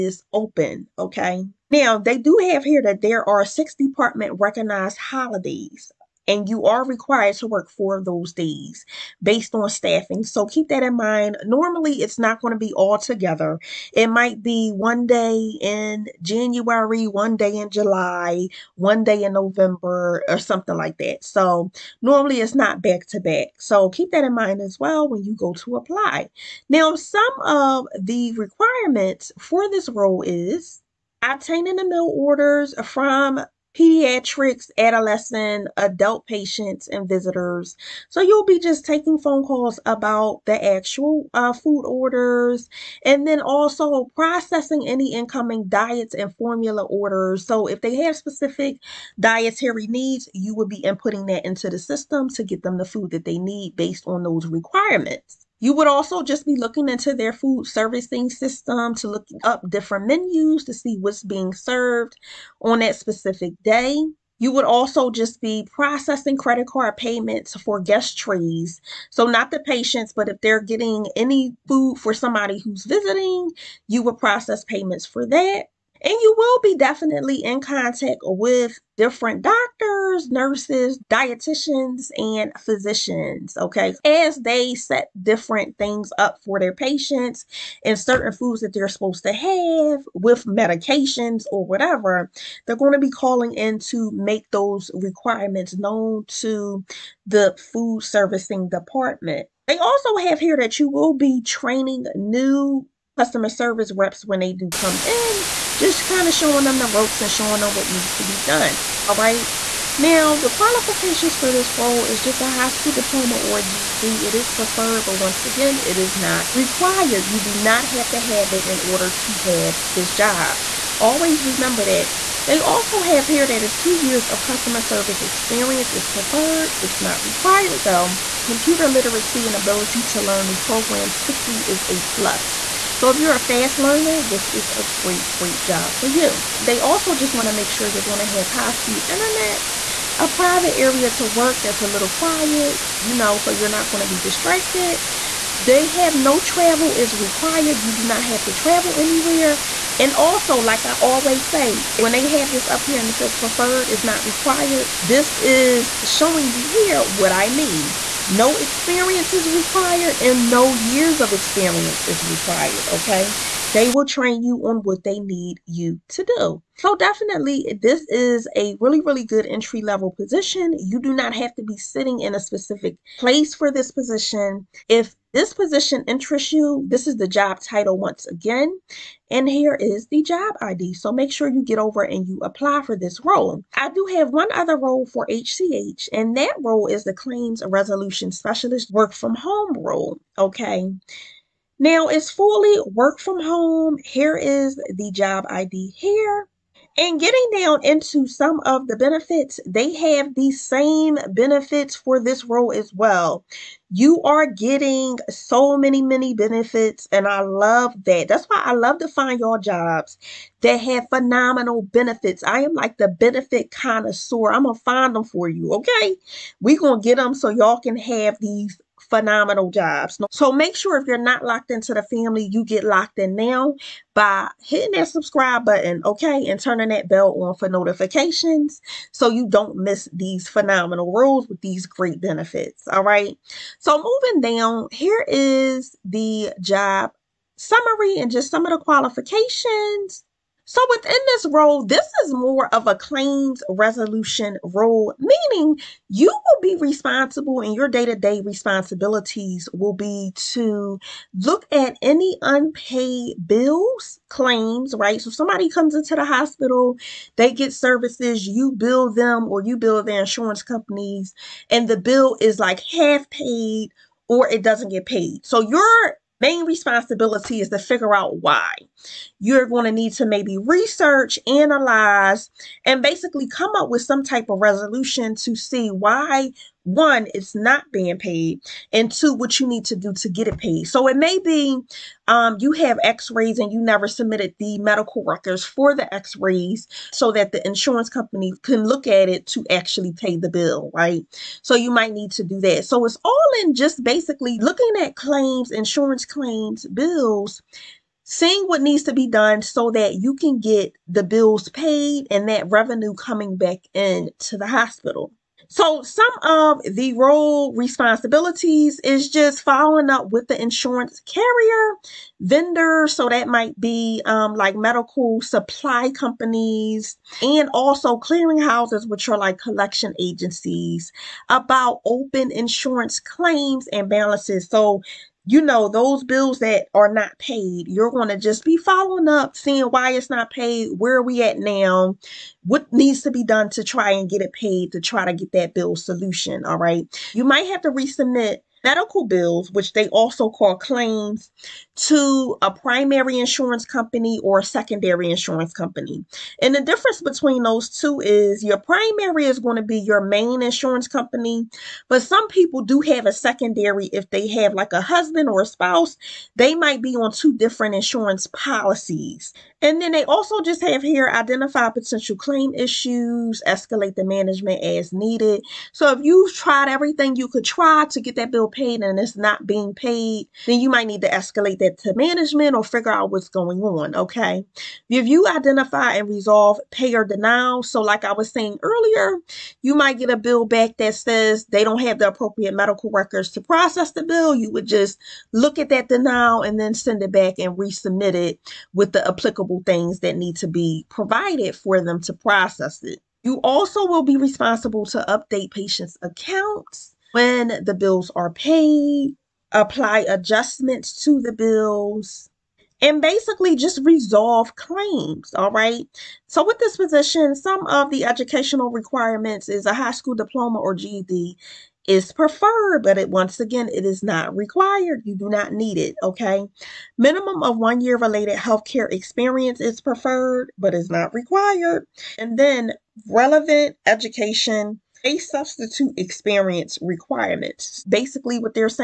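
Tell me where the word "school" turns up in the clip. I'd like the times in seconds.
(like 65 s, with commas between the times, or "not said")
112 s, 410 s.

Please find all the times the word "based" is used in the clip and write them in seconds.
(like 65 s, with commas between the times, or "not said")
9 s, 53 s.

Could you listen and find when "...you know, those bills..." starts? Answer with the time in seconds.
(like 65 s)
325 s.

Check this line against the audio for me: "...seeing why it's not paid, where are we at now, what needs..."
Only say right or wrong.
right.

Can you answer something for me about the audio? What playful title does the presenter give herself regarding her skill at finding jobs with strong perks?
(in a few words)
Benefit connoisseur.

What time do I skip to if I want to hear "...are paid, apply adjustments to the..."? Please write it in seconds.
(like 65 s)
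398 s.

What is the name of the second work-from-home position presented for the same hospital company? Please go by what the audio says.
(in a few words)
Claims Resolution Specialist.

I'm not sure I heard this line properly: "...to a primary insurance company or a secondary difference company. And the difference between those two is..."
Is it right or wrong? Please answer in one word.
wrong.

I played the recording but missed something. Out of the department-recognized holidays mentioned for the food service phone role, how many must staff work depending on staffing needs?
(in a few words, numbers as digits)
4.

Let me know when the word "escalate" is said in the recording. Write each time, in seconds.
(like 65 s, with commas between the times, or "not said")
363 s, 371 s.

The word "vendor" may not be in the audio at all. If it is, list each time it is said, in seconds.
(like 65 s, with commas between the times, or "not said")
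312 s.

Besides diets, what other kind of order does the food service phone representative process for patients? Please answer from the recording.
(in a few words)
Formula orders.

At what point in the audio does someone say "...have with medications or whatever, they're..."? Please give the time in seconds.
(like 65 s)
89 s.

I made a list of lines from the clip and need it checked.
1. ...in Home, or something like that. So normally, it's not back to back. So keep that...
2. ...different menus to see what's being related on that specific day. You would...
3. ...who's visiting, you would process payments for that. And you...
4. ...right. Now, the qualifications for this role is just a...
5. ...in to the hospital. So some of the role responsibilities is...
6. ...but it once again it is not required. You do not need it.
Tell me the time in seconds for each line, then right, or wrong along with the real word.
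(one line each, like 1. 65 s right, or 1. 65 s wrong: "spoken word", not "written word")
1. 19 s wrong: "November", not "Home"
2. 59 s wrong: "served", not "related"
3. 72 s right
4. 109 s right
5. 303 s right
6. 413 s right.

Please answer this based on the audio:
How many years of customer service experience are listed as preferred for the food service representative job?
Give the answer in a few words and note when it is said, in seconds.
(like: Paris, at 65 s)
2, at 123 s.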